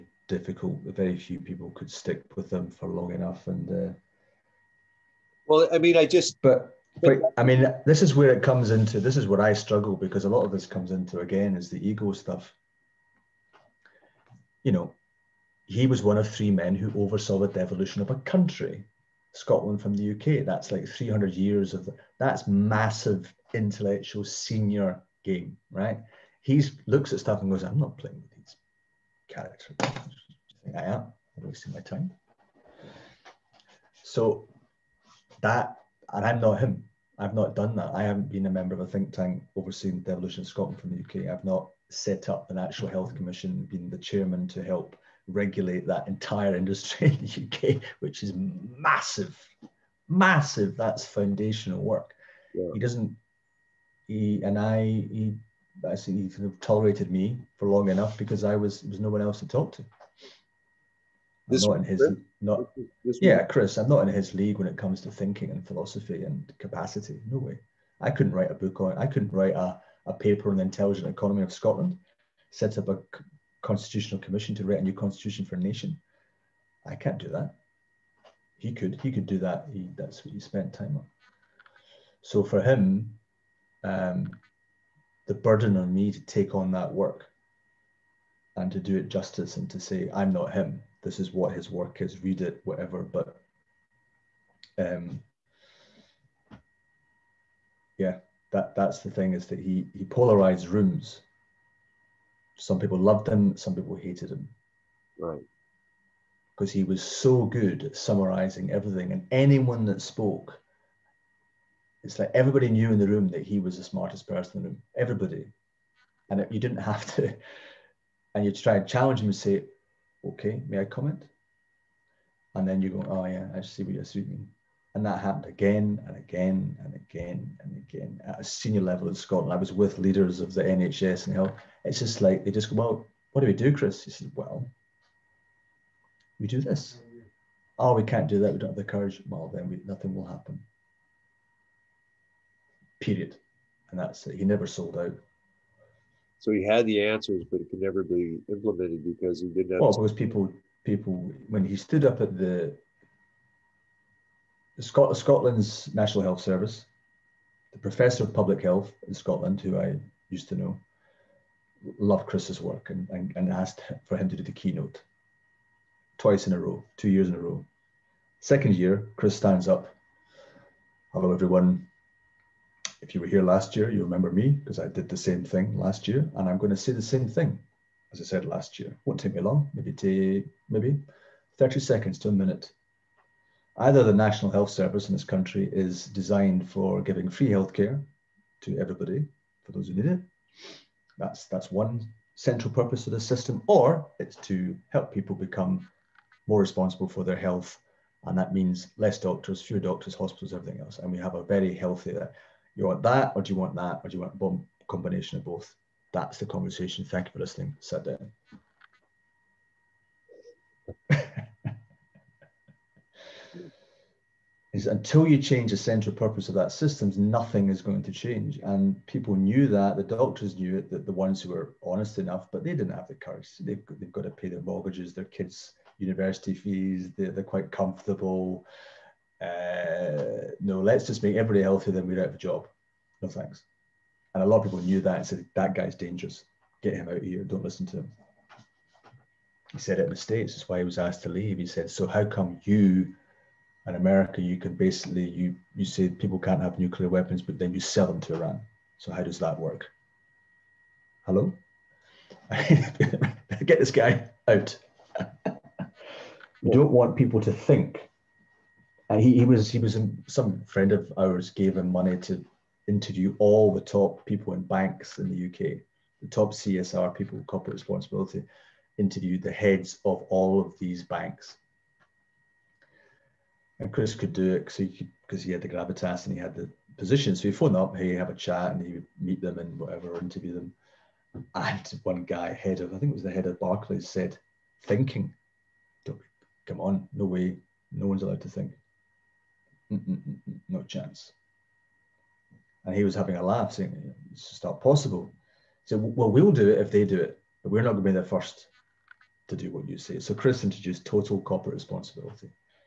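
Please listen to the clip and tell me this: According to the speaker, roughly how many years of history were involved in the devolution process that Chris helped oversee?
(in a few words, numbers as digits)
300 years.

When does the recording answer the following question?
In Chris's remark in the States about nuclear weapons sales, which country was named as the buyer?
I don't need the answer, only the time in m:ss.
4:08.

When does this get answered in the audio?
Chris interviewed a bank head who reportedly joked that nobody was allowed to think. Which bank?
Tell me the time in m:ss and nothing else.
4:43.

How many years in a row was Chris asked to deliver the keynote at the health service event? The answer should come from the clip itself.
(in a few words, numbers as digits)
2.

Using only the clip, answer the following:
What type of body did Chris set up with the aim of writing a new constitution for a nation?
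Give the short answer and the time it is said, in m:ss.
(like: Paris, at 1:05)
constitutional commission, at 1:13.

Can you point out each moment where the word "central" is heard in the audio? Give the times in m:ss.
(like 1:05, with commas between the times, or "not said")
3:12, 3:35.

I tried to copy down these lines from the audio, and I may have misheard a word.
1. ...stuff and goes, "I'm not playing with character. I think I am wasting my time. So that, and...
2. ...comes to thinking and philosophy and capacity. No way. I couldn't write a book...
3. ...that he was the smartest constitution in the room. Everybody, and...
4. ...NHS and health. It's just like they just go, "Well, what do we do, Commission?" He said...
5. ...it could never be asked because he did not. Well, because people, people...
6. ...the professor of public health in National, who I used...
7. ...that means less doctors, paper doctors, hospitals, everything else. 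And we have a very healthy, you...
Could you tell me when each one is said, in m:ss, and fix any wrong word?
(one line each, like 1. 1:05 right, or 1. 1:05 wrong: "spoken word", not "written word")
1. 0:27 right
2. 1:04 right
3. 1:53 wrong: "person", not "constitution"
4. 2:10 wrong: "Chris", not "Commission"
5. 2:27 wrong: "implemented", not "asked"
6. 2:37 wrong: "Scotland", not "National"
7. 3:18 wrong: "fewer", not "paper".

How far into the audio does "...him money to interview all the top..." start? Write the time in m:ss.
4:21.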